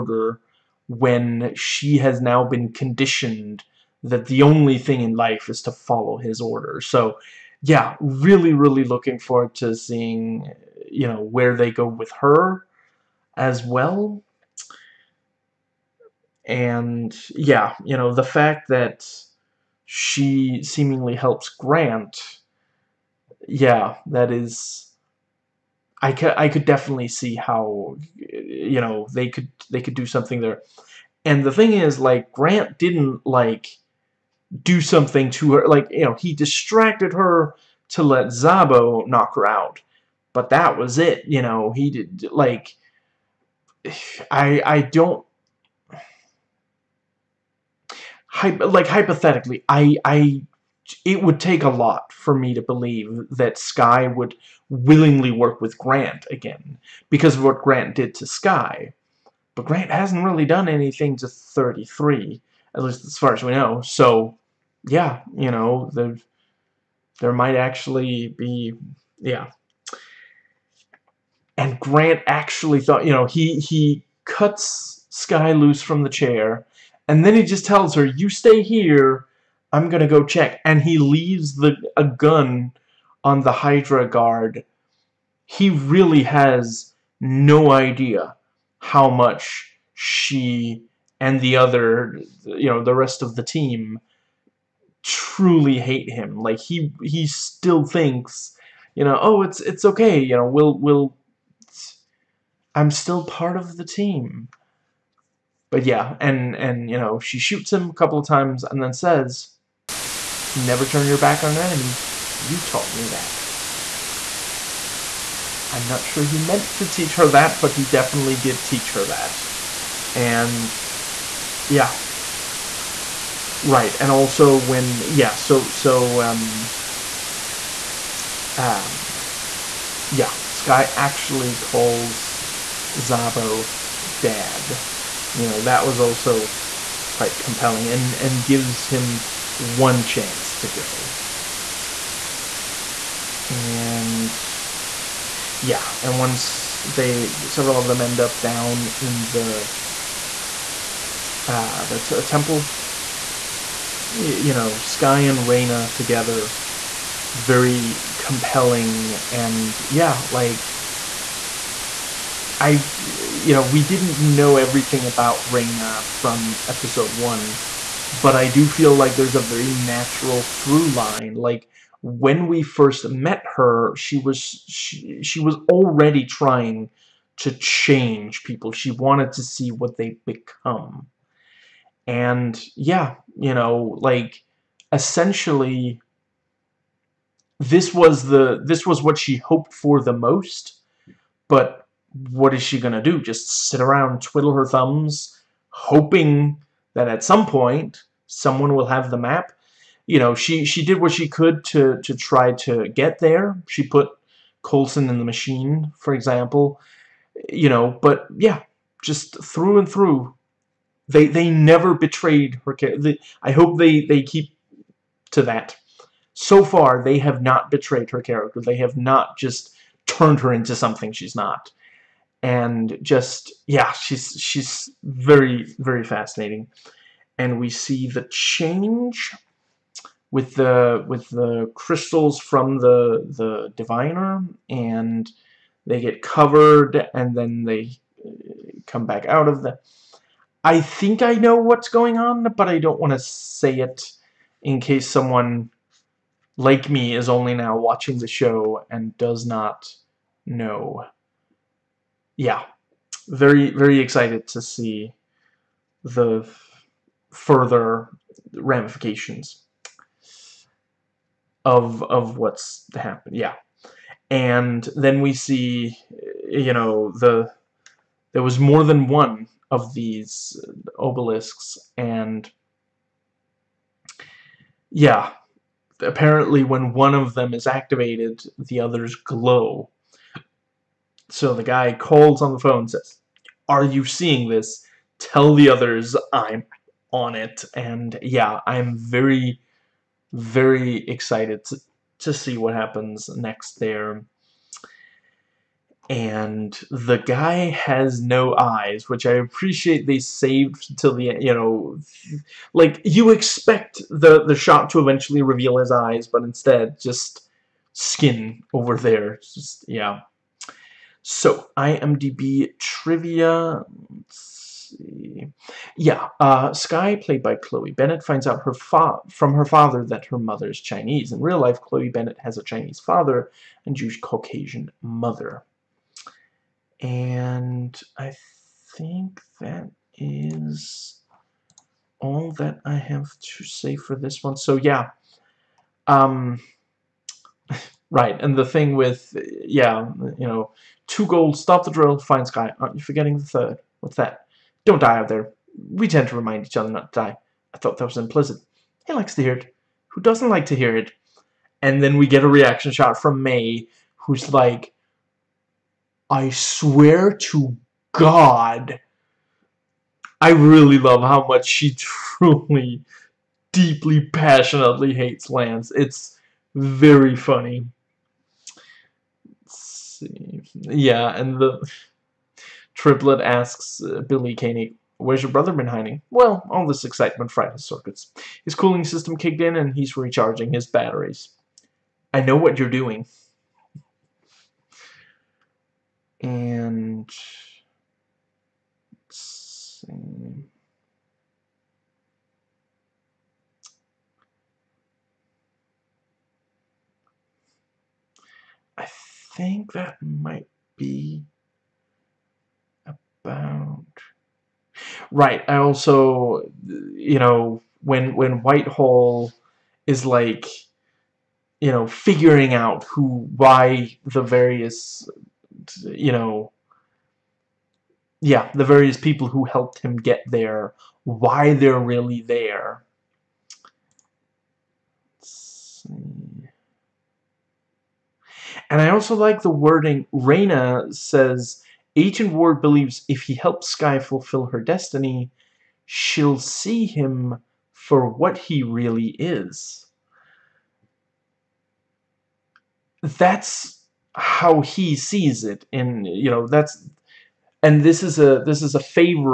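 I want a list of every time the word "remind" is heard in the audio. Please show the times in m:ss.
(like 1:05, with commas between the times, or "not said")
5:46.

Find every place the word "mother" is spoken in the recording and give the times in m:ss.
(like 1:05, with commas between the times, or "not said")
5:20, 5:25.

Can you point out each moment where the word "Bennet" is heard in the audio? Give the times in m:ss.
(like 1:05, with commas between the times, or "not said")
5:17, 5:22.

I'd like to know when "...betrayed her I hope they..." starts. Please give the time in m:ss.
3:31.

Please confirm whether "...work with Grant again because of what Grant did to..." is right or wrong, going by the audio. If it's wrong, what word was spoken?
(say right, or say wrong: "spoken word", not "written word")
right.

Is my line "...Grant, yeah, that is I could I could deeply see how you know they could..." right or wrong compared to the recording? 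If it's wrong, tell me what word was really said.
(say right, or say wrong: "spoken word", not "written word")
wrong: "definitely", not "deeply".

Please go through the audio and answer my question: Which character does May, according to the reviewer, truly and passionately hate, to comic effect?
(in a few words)
Lance.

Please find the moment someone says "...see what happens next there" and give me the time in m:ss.
4:52.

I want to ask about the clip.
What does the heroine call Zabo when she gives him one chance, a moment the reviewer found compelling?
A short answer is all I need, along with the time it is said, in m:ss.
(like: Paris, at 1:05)
Dad, at 2:14.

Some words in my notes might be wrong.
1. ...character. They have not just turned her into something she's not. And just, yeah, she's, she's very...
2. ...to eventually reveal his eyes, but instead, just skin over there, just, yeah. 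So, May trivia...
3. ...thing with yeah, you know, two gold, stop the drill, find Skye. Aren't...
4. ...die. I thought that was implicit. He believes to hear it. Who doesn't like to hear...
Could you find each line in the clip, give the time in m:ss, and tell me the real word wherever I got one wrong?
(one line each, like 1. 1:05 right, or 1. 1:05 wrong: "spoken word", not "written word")
1. 3:38 right
2. 5:04 wrong: "IMDb", not "May"
3. 5:38 right
4. 5:47 wrong: "likes", not "believes".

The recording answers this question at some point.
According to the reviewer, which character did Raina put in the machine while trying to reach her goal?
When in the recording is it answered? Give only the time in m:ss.
3:24.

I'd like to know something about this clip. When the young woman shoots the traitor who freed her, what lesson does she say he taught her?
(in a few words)
Never turn your back on an enemy.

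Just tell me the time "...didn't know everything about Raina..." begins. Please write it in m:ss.
2:43.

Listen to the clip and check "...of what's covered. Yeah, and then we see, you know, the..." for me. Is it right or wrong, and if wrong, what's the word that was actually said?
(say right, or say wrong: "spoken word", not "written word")
wrong: "happened", not "covered".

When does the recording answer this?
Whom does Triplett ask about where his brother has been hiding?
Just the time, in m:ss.
6:14.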